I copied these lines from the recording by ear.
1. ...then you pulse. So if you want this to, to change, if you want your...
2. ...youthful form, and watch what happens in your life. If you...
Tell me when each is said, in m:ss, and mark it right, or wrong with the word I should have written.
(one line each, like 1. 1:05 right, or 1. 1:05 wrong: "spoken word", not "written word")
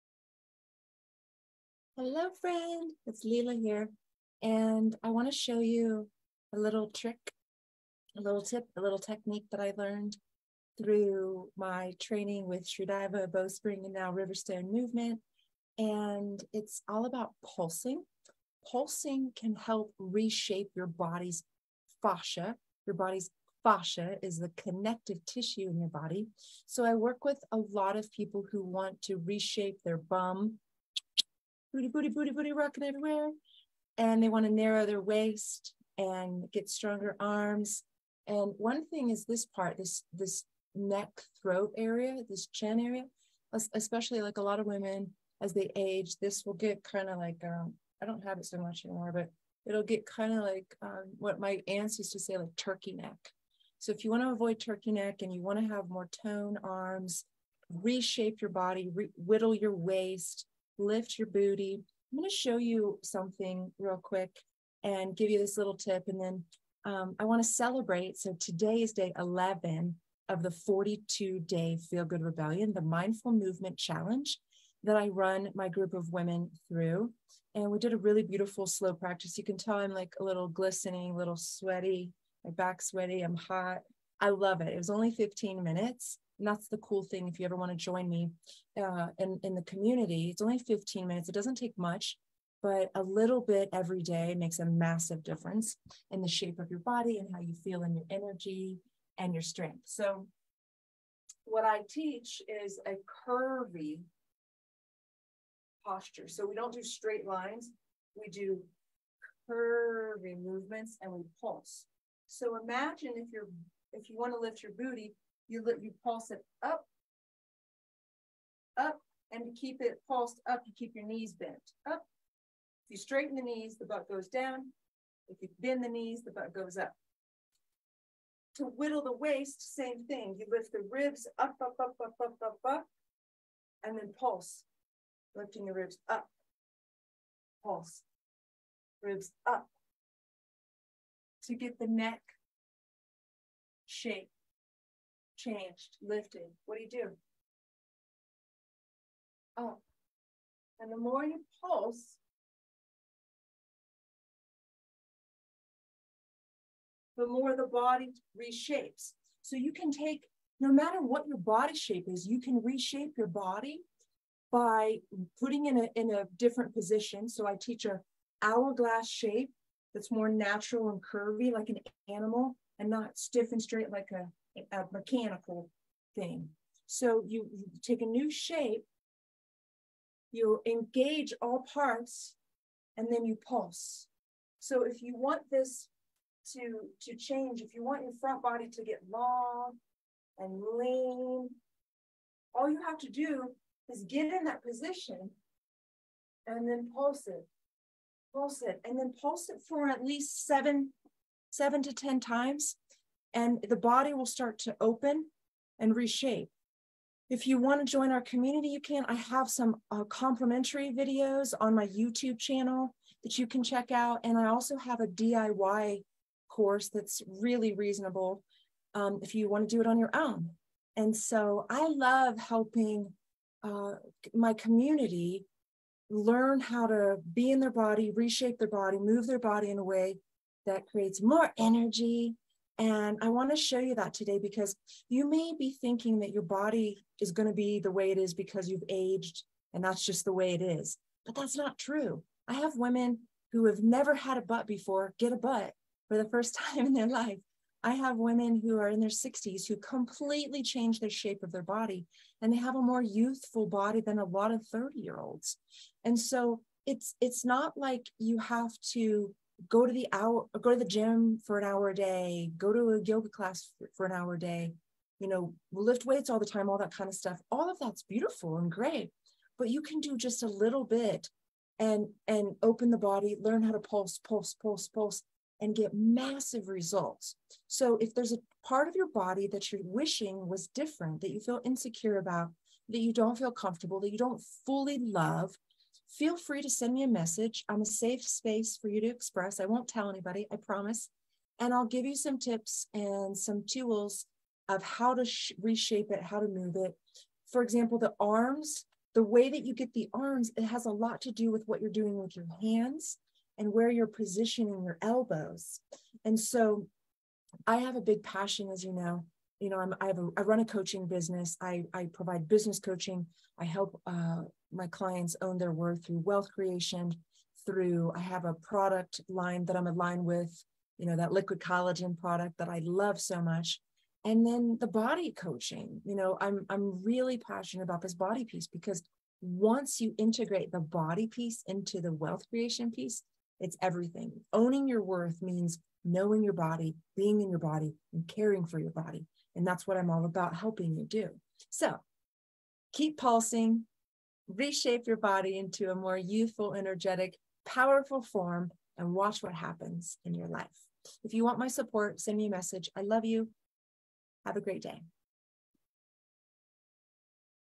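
1. 3:03 right
2. 5:47 wrong: "powerful", not "youthful".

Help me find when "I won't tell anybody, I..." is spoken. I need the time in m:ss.
4:49.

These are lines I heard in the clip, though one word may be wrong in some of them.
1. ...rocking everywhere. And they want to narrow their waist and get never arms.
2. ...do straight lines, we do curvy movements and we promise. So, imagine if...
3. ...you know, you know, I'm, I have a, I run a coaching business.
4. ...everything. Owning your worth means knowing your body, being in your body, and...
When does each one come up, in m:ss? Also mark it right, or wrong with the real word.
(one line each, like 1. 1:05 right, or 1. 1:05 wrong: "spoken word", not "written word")
1. 0:32 wrong: "stronger", not "never"
2. 1:46 wrong: "pulse", not "promise"
3. 5:08 right
4. 5:33 right.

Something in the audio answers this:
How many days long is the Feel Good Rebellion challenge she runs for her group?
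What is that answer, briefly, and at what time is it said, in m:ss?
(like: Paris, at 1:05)
42, at 1:10.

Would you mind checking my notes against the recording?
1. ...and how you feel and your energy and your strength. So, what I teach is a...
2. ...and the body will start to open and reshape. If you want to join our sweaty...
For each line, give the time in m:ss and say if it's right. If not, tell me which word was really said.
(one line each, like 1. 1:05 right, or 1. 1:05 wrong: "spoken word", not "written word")
1. 1:37 right
2. 3:23 wrong: "community", not "sweaty".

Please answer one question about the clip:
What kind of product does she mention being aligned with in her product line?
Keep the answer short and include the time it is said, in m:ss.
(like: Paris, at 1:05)
Liquid collagen, at 5:21.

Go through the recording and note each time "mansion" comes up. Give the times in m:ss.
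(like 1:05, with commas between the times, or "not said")
not said.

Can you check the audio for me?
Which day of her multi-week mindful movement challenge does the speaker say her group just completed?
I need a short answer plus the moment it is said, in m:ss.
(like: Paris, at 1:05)
Day 11, at 1:08.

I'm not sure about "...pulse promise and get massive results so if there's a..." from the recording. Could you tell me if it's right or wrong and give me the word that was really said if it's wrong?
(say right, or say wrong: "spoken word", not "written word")
wrong: "pulse", not "promise".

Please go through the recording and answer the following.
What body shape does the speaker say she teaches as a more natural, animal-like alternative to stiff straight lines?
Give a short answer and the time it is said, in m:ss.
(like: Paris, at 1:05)
Hourglass, at 2:48.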